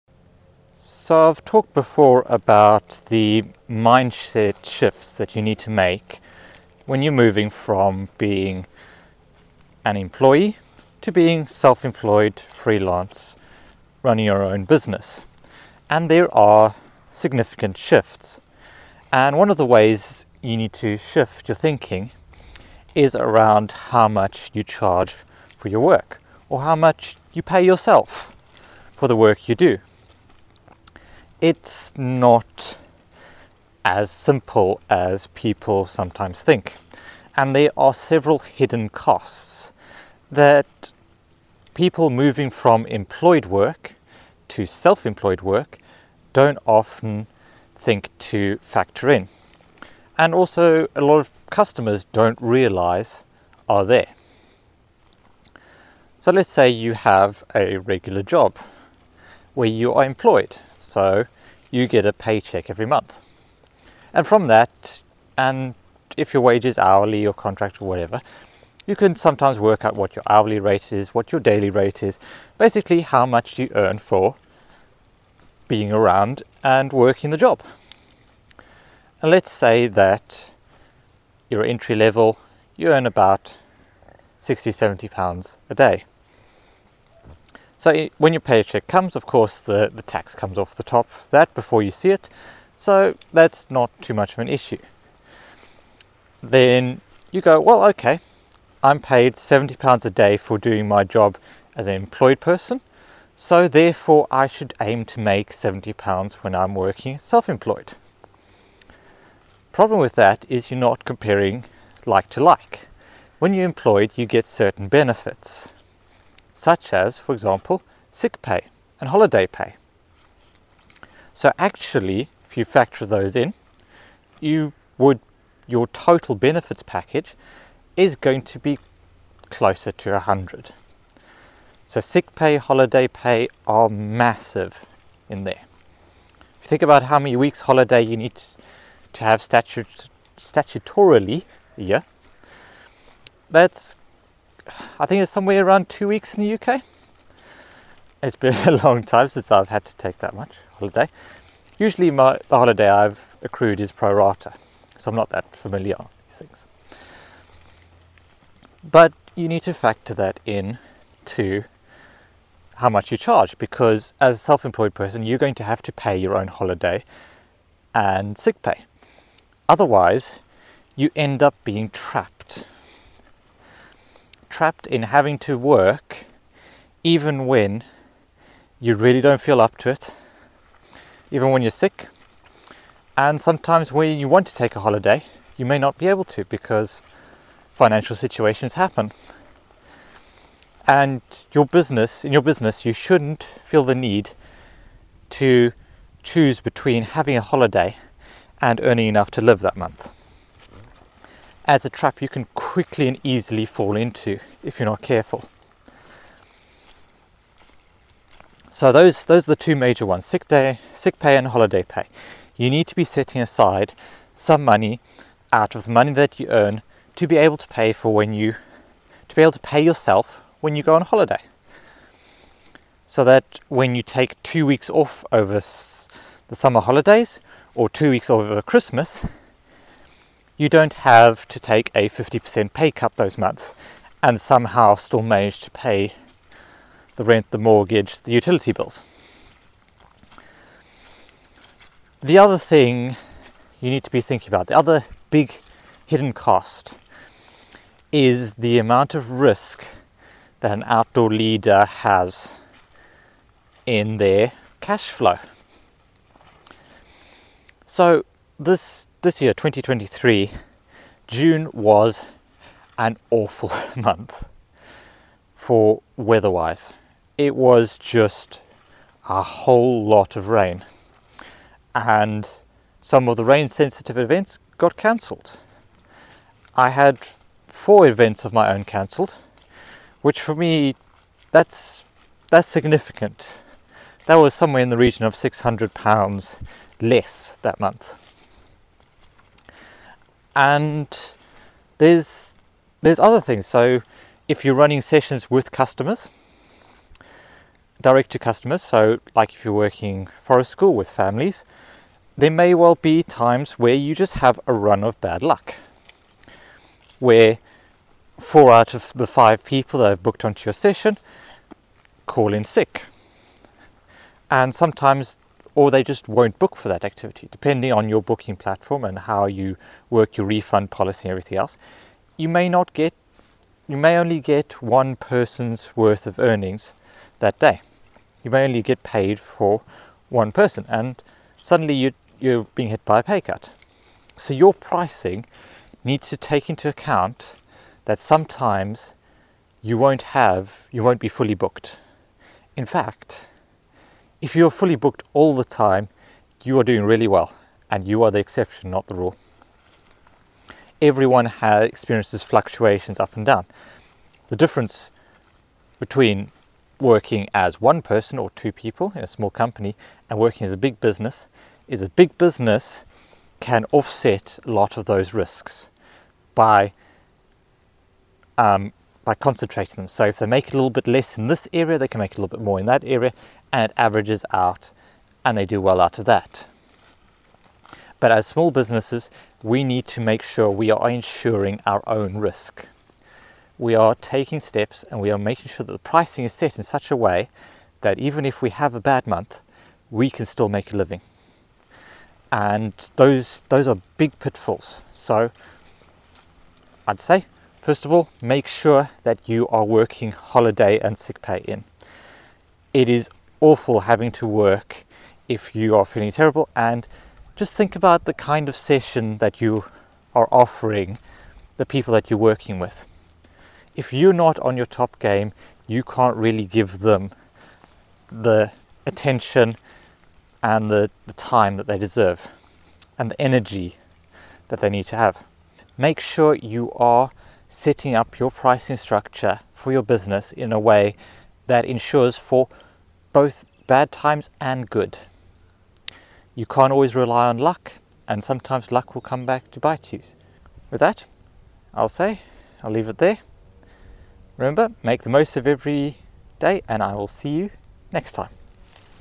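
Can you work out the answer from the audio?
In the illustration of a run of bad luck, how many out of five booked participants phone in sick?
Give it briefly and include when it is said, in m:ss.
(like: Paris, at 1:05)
4, at 5:08.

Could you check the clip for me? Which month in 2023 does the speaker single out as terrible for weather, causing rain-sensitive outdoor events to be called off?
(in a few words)
June.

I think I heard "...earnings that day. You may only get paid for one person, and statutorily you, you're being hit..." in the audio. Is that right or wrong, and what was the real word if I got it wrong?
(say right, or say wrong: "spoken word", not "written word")
wrong: "suddenly", not "statutorily".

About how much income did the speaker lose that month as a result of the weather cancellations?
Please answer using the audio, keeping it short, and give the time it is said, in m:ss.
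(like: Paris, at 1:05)
£600, at 4:45.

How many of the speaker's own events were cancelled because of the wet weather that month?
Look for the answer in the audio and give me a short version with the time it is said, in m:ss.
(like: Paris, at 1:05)
4, at 4:37.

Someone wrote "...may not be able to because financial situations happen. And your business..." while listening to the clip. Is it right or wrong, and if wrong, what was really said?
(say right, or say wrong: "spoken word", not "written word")
right.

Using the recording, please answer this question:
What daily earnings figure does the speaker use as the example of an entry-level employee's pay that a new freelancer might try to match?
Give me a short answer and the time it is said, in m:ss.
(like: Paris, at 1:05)
£70 a day, at 1:39.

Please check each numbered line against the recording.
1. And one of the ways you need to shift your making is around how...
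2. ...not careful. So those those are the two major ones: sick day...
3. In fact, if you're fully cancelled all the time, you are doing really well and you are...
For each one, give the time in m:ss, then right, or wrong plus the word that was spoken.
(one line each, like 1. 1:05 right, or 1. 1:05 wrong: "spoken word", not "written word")
1. 0:19 wrong: "thinking", not "making"
2. 3:24 right
3. 5:42 wrong: "booked", not "cancelled".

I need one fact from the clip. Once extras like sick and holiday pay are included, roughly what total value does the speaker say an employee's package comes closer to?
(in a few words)
100.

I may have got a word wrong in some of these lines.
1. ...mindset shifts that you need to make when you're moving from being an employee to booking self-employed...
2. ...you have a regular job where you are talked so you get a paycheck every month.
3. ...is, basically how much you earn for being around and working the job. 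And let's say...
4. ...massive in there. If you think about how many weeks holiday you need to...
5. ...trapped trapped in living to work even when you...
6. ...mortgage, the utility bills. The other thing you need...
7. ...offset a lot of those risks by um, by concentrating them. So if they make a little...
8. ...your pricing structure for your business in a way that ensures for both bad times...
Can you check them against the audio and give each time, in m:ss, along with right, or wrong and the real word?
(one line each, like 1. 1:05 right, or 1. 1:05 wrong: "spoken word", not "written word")
1. 0:03 wrong: "being", not "booking"
2. 0:56 wrong: "employed", not "talked"
3. 1:12 right
4. 2:13 right
5. 2:51 wrong: "having", not "living"
6. 3:57 right
7. 6:03 right
8. 7:08 right.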